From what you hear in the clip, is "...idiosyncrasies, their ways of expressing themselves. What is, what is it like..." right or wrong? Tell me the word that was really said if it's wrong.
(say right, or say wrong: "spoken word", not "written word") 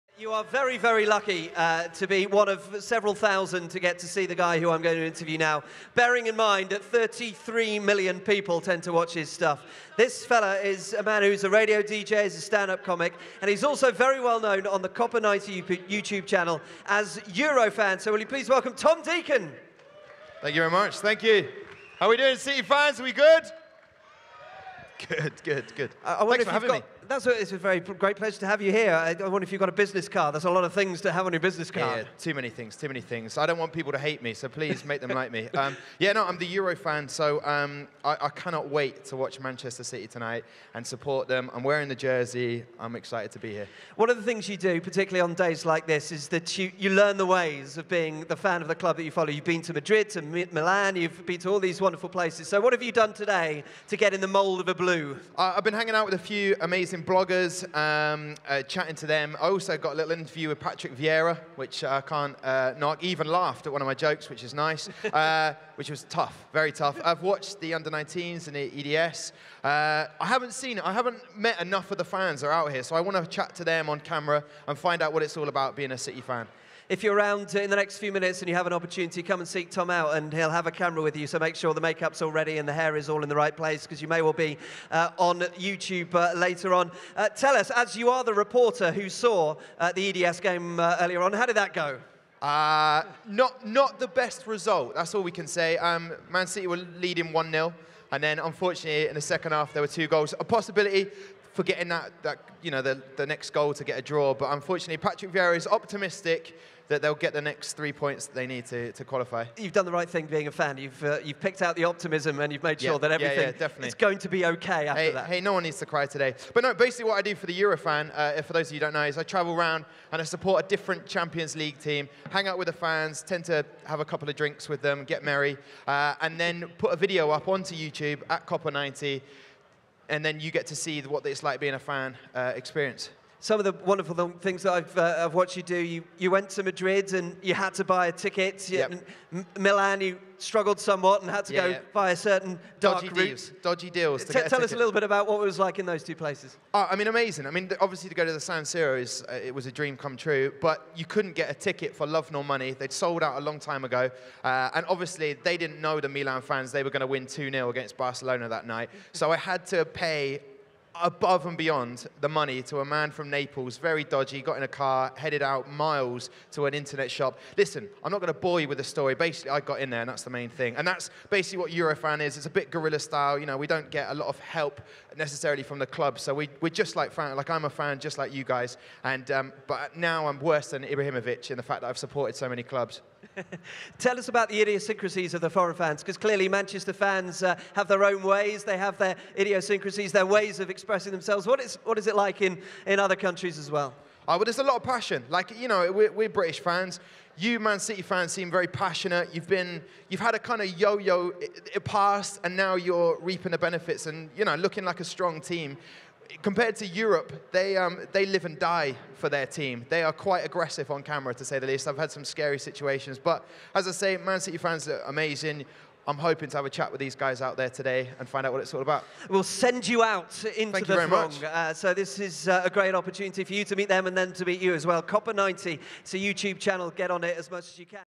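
right.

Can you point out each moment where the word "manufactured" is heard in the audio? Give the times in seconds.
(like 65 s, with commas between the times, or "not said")
not said.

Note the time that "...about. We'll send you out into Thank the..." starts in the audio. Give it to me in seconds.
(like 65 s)
218 s.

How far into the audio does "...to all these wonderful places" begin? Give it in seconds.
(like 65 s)
51 s.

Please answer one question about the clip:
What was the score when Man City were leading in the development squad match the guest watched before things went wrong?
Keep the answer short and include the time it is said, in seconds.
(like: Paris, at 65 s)
1-0, at 97 s.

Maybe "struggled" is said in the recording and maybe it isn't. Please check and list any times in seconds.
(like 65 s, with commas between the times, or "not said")
140 s.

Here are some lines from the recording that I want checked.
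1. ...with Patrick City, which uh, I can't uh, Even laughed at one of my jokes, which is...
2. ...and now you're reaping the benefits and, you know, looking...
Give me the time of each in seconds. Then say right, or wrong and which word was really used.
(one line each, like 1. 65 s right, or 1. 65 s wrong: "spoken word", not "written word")
1. 60 s wrong: "Vieira", not "City"
2. 202 s right.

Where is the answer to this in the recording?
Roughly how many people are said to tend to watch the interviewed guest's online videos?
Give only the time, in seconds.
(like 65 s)
6 s.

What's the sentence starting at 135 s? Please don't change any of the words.
You, you went to Madrid and you had to buy a ticket.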